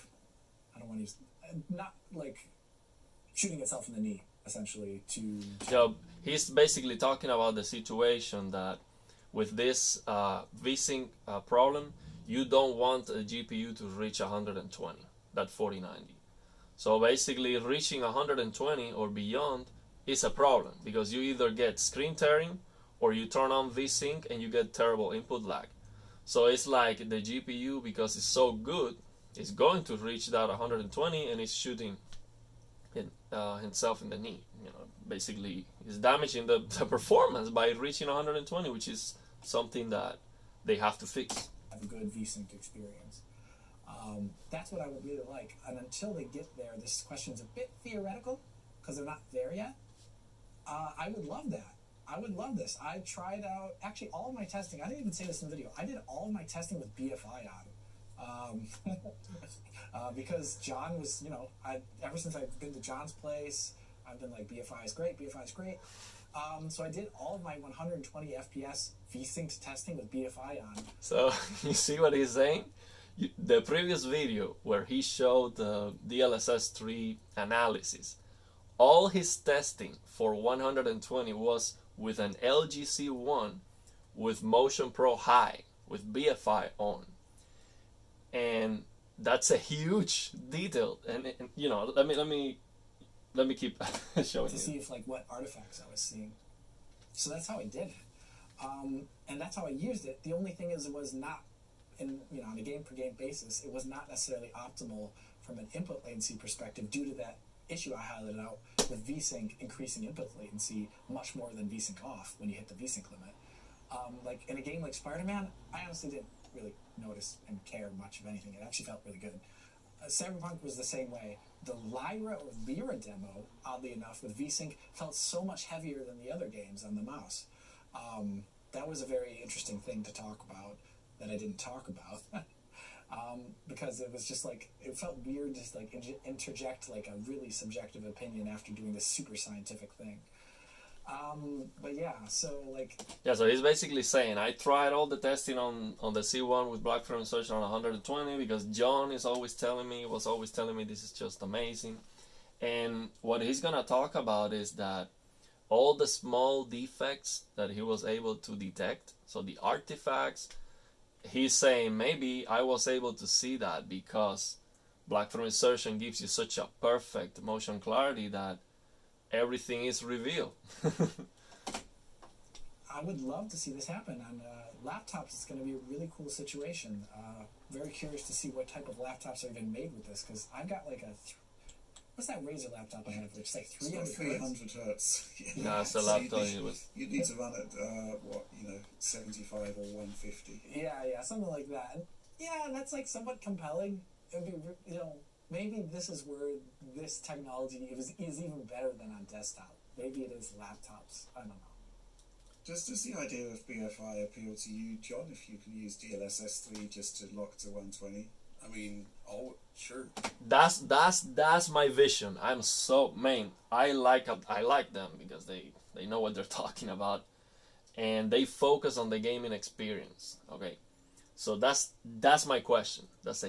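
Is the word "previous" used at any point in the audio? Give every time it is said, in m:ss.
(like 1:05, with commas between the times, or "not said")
1:13.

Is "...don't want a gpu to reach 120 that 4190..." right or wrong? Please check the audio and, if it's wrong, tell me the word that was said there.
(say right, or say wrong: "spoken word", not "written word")
wrong: "4090", not "4190".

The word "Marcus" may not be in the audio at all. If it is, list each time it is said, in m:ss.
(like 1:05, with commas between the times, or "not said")
not said.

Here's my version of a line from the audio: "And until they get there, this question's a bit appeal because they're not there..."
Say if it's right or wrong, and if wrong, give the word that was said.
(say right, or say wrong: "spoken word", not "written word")
wrong: "theoretical", not "appeal".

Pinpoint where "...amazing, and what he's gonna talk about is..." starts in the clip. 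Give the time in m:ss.
2:31.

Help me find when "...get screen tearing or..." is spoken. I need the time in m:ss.
0:21.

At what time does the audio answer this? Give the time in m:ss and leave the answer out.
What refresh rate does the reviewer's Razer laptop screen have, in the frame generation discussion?
3:04.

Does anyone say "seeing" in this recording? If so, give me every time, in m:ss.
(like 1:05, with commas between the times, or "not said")
1:35.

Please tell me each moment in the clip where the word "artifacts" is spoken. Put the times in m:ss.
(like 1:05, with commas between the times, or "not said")
1:35, 2:39.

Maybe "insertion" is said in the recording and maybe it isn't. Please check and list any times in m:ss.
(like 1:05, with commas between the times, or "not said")
2:27, 2:45.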